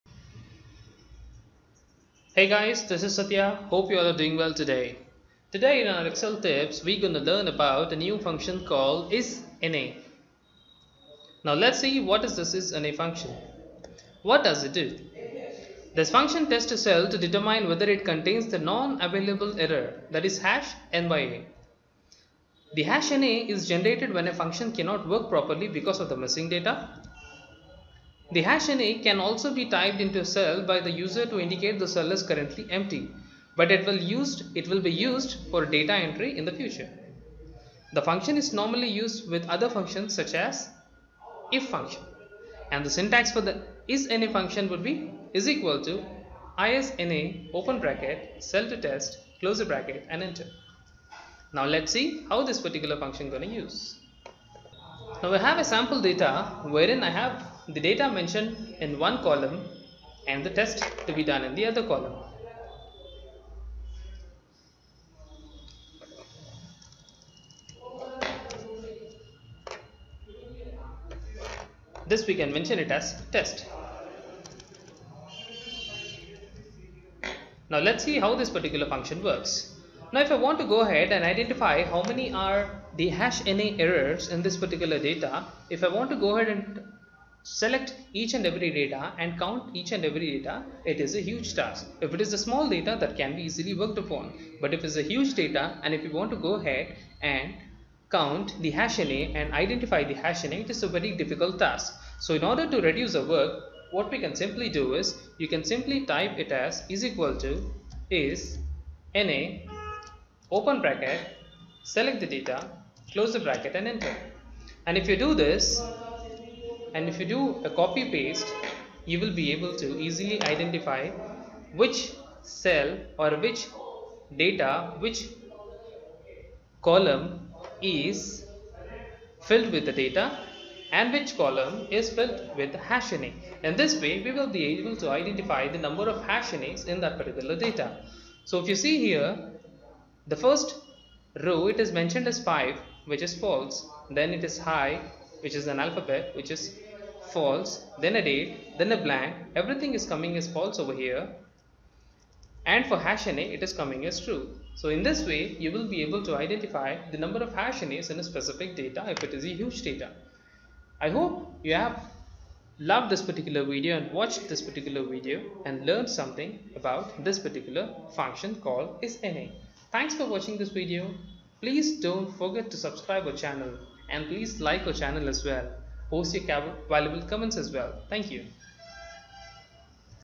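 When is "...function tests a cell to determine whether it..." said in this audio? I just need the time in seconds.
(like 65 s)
16 s.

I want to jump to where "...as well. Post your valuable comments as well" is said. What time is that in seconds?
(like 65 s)
175 s.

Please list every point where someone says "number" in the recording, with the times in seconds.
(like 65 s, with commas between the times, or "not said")
135 s, 157 s.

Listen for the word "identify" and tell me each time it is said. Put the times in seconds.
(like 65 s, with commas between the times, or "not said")
81 s, 99 s, 120 s, 135 s, 156 s.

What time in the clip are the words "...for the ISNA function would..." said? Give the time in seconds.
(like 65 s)
43 s.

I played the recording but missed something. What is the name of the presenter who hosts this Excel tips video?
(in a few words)
Satya.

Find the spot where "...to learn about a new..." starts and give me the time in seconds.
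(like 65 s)
7 s.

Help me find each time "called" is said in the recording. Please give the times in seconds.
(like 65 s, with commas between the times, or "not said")
8 s, 168 s.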